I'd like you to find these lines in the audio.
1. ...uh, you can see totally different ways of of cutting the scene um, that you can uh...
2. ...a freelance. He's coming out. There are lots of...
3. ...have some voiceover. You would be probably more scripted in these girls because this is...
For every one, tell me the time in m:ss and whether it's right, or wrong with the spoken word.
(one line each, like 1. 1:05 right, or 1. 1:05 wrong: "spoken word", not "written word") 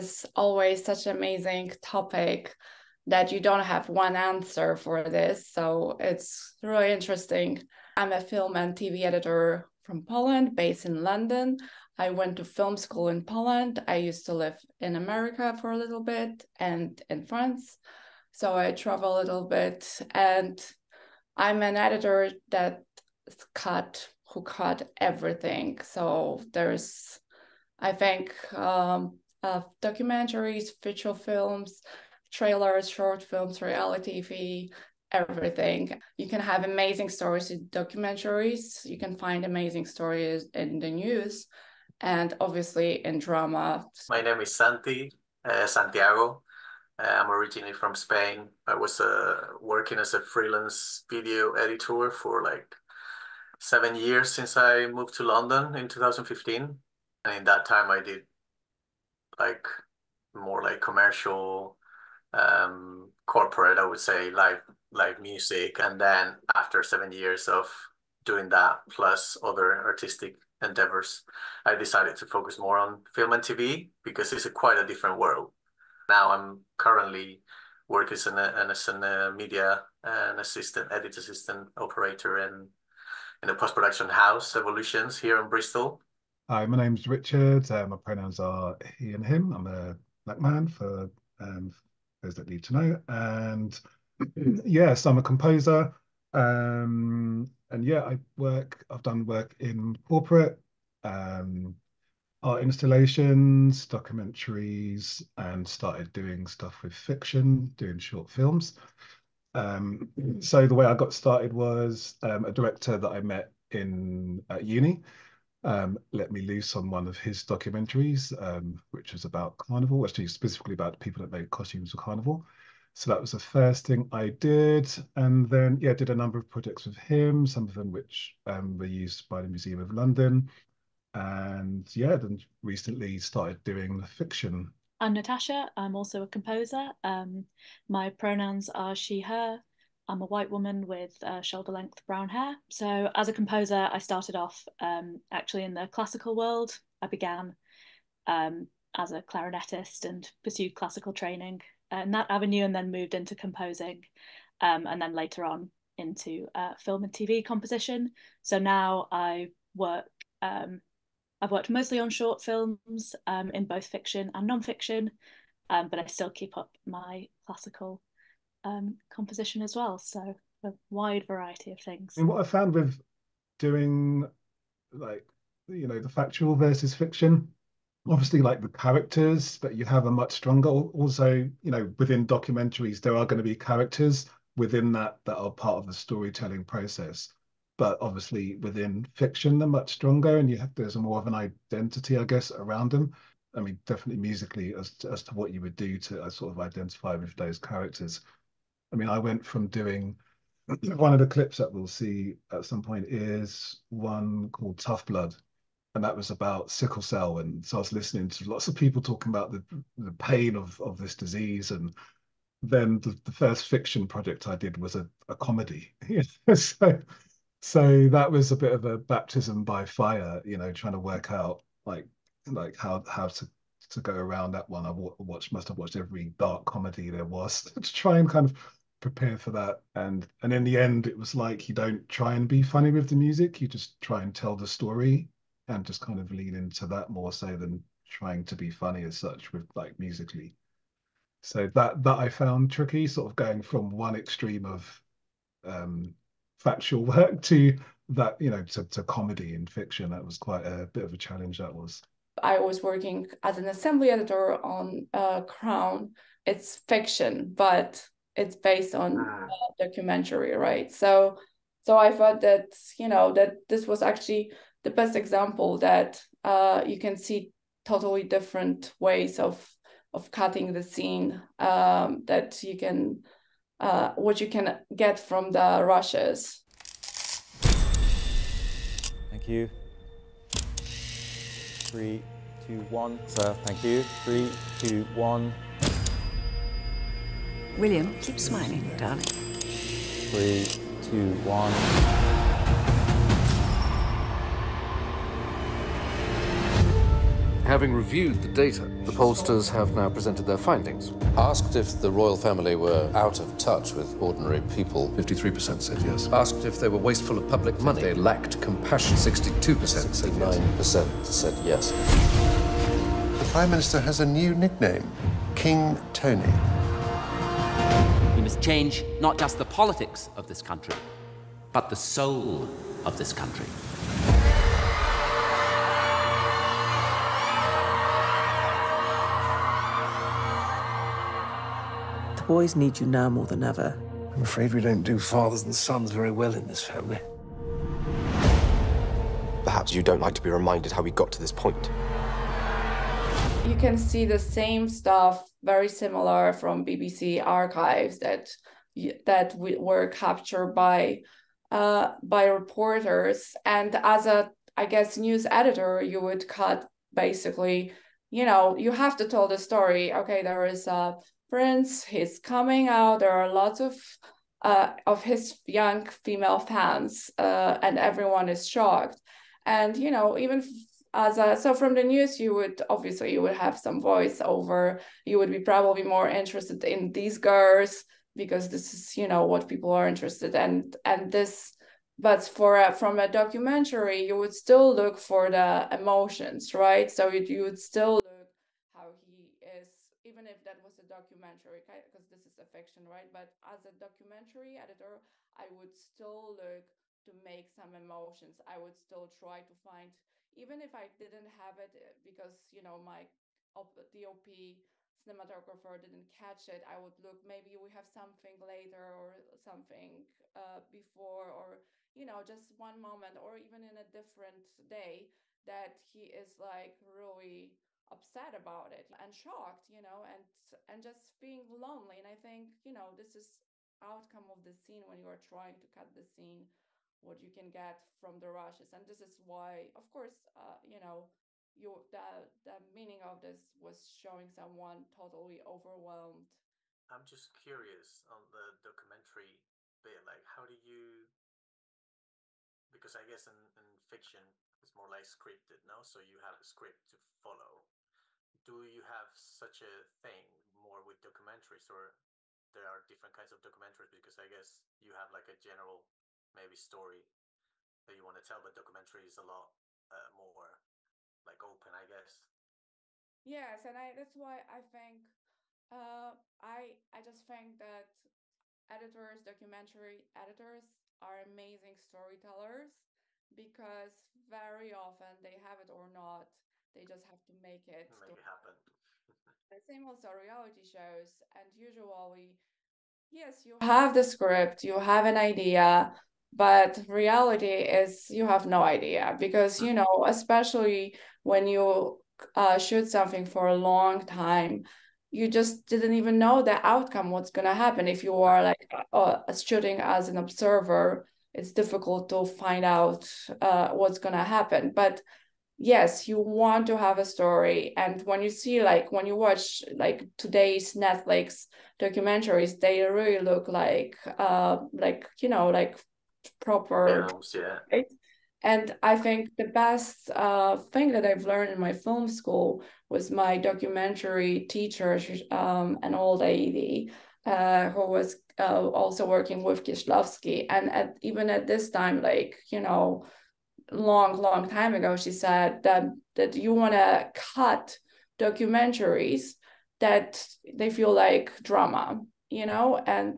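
1. 4:26 right
2. 6:00 wrong: "prince", not "freelance"
3. 6:13 wrong: "interested", not "scripted".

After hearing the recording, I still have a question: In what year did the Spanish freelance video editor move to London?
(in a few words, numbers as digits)
2015.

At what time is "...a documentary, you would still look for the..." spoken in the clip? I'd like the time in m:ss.
6:23.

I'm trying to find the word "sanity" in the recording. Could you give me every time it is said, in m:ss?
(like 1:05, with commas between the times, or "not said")
not said.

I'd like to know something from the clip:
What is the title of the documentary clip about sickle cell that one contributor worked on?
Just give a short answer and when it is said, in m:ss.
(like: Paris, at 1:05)
Tough Blood, at 3:24.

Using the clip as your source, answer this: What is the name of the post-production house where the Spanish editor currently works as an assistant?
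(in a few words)
Evolutions.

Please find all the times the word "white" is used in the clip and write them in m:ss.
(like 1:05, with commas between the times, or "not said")
2:20.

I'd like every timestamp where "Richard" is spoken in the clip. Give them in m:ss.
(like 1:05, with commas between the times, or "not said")
1:27.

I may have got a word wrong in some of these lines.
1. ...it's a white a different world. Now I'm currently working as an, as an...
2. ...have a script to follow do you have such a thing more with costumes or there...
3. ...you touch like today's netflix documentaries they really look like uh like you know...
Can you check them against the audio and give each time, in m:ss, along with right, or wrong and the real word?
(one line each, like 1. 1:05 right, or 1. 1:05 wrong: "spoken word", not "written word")
1. 1:14 wrong: "quite", not "white"
2. 7:26 wrong: "documentaries", not "costumes"
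3. 8:29 wrong: "watch", not "touch".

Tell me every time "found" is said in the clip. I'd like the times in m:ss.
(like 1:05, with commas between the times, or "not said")
2:52, 4:02.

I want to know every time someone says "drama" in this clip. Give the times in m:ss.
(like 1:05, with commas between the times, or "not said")
0:43, 9:01.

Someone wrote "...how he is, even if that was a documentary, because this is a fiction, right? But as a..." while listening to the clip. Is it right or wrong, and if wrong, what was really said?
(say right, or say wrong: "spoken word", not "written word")
right.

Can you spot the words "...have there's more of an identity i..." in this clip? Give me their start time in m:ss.
3:10.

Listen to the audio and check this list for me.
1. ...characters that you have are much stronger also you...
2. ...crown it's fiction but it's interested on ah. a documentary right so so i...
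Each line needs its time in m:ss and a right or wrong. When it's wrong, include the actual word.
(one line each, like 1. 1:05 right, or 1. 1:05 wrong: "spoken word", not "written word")
1. 2:58 right
2. 4:15 wrong: "based", not "interested".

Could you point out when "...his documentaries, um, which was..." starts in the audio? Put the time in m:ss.
1:57.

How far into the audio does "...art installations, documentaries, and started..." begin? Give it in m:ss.
1:42.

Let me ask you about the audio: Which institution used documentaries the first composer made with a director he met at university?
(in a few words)
Museum of London.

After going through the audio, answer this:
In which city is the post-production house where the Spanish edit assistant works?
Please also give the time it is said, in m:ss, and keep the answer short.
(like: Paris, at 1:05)
Bristol, at 1:25.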